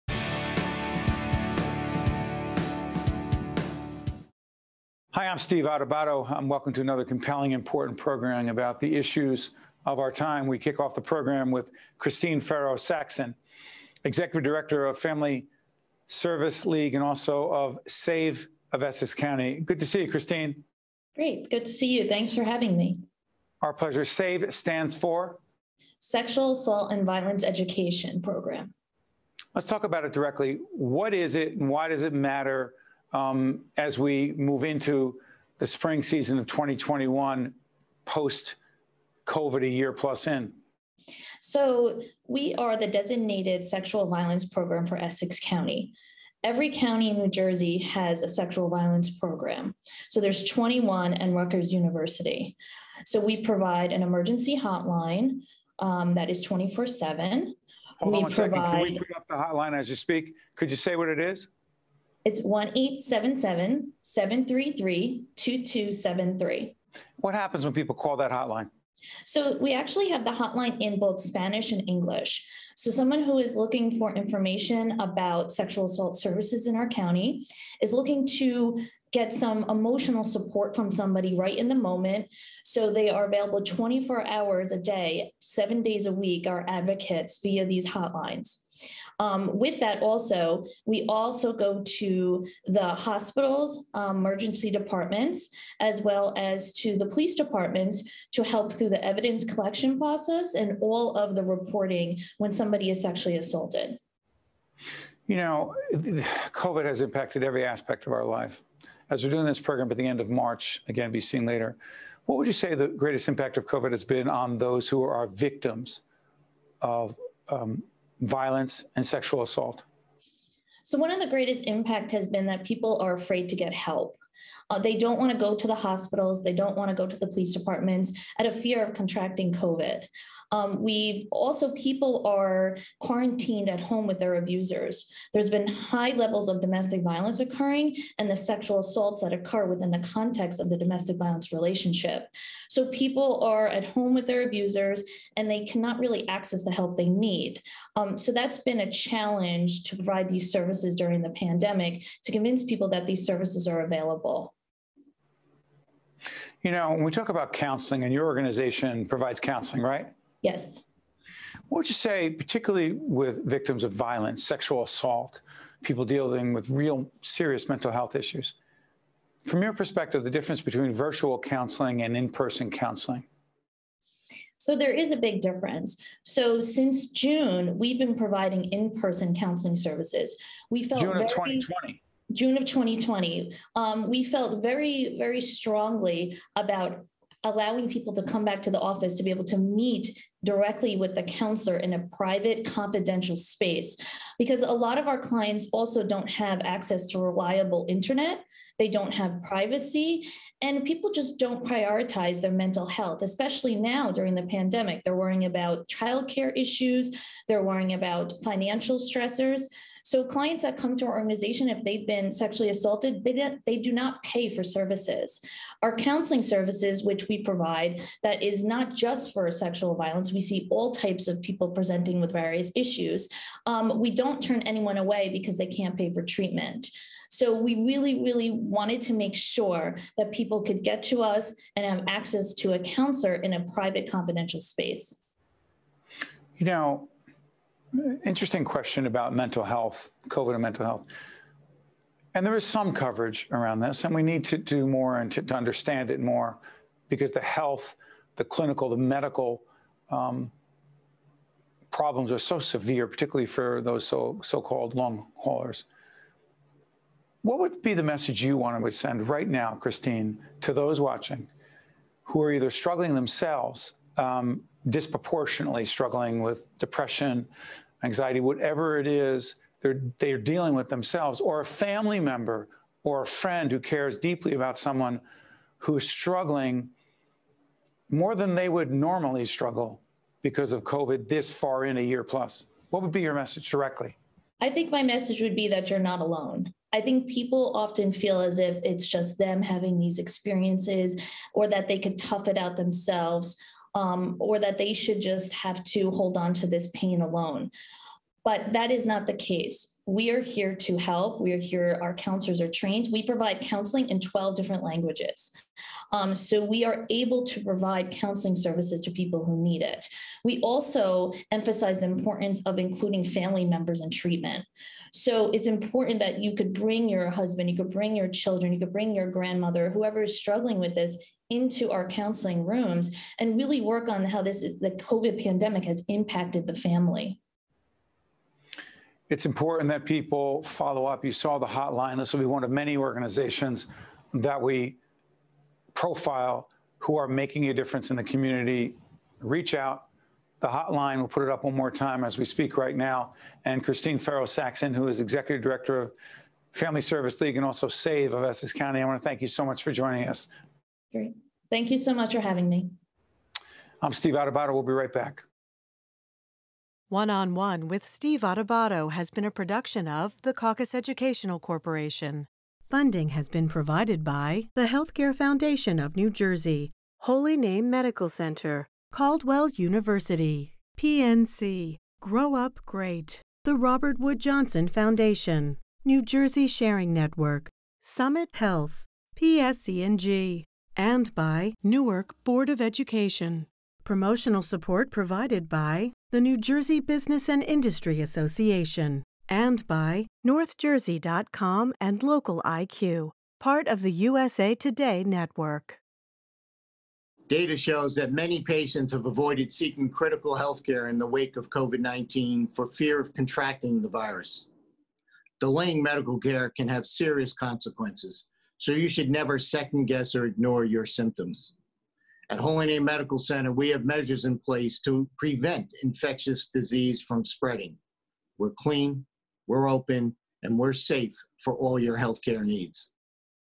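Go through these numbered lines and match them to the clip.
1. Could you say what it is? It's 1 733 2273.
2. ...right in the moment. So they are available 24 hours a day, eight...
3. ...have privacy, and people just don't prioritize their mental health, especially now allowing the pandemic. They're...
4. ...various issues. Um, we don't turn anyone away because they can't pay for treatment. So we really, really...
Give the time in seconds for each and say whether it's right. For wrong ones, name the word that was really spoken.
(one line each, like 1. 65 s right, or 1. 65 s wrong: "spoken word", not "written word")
1. 60 s right
2. 81 s wrong: "seven", not "eight"
3. 199 s wrong: "during", not "allowing"
4. 222 s right.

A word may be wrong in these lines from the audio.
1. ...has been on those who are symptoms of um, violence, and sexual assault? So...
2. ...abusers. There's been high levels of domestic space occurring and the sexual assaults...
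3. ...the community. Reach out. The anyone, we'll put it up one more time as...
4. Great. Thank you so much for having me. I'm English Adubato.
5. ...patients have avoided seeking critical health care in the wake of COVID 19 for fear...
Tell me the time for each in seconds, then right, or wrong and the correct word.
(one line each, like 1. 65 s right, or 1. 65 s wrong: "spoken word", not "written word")
1. 113 s wrong: "victims", not "symptoms"
2. 134 s wrong: "violence", not "space"
3. 338 s wrong: "hotline", not "anyone"
4. 351 s wrong: "Steve", not "English"
5. 398 s right.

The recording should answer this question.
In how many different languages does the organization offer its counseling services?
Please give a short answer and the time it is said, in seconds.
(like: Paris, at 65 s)
12, at 304 s.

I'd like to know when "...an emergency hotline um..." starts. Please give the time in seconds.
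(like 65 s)
53 s.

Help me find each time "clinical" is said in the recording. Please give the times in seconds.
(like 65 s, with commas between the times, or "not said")
248 s.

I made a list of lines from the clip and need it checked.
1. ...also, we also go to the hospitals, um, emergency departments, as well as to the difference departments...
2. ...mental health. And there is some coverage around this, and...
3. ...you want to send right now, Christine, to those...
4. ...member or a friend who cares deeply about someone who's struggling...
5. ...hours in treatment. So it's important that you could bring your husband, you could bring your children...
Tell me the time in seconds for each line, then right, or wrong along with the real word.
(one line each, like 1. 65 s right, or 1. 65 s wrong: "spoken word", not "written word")
1. 90 s wrong: "police", not "difference"
2. 240 s right
3. 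258 s right
4. 272 s right
5. 313 s wrong: "members", not "hours".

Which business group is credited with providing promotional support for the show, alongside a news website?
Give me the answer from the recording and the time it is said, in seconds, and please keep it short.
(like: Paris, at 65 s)
New Jersey Business and Industry Association, at 386 s.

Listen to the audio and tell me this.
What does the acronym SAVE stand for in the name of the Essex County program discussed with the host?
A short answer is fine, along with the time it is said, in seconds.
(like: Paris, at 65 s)
Sexual Assault and Violence Education, at 25 s.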